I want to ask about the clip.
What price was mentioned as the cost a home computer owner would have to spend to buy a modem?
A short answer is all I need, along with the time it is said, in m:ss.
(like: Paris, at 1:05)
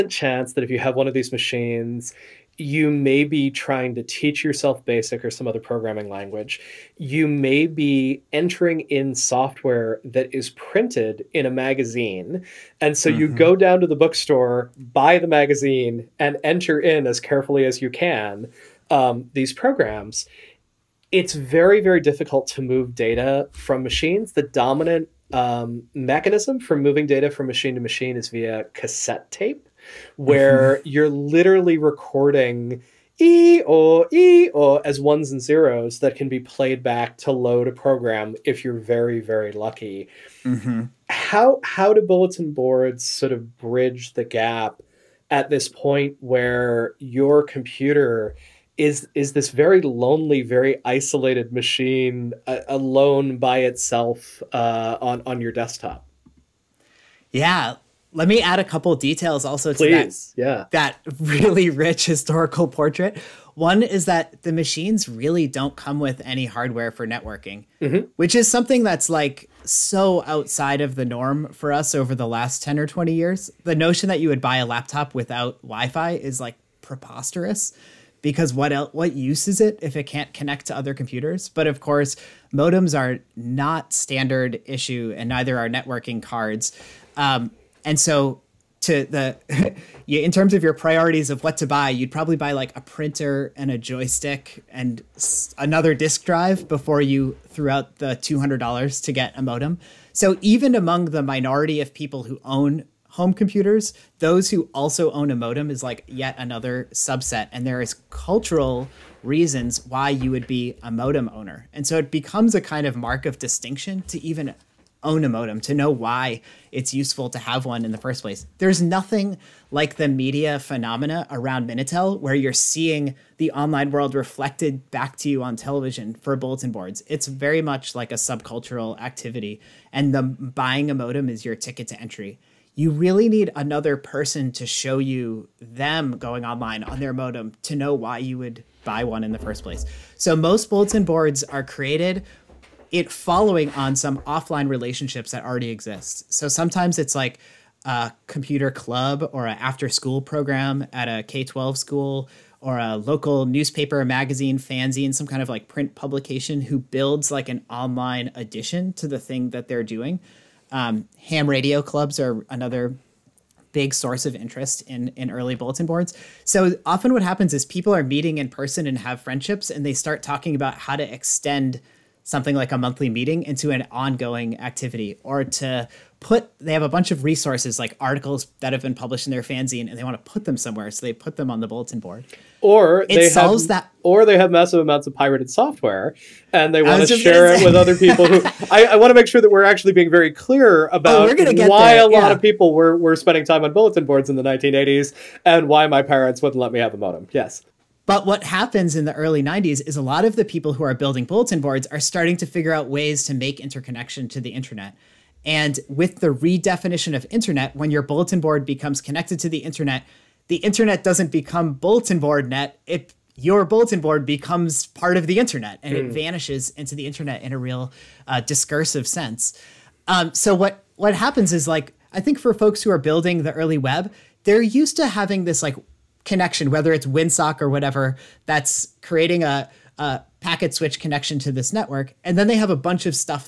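$200, at 1:38.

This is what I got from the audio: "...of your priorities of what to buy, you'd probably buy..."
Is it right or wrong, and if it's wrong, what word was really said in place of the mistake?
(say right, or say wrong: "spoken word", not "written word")
right.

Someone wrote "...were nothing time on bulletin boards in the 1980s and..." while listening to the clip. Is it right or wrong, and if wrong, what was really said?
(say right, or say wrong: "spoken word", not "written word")
wrong: "spending", not "nothing".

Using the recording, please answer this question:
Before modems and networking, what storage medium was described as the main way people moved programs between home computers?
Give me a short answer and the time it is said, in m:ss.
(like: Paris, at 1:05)
cassette tape, at 0:28.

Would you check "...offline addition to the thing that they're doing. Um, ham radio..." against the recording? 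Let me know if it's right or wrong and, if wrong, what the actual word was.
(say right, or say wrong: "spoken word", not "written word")
wrong: "online", not "offline".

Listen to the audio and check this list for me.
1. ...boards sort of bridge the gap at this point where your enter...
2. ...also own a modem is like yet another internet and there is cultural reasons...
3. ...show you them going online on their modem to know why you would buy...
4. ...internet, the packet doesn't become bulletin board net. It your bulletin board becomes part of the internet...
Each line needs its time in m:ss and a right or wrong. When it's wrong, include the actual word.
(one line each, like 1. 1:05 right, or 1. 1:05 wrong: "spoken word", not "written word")
1. 0:42 wrong: "computer", not "enter"
2. 1:44 wrong: "subset", not "internet"
3. 2:14 right
4. 3:29 wrong: "internet", not "packet".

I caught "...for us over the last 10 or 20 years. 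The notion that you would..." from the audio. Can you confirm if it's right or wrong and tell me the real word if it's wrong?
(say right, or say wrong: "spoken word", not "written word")
right.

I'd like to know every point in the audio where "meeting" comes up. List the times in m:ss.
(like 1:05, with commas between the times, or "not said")
2:48, 2:53.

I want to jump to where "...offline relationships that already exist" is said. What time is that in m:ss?
2:24.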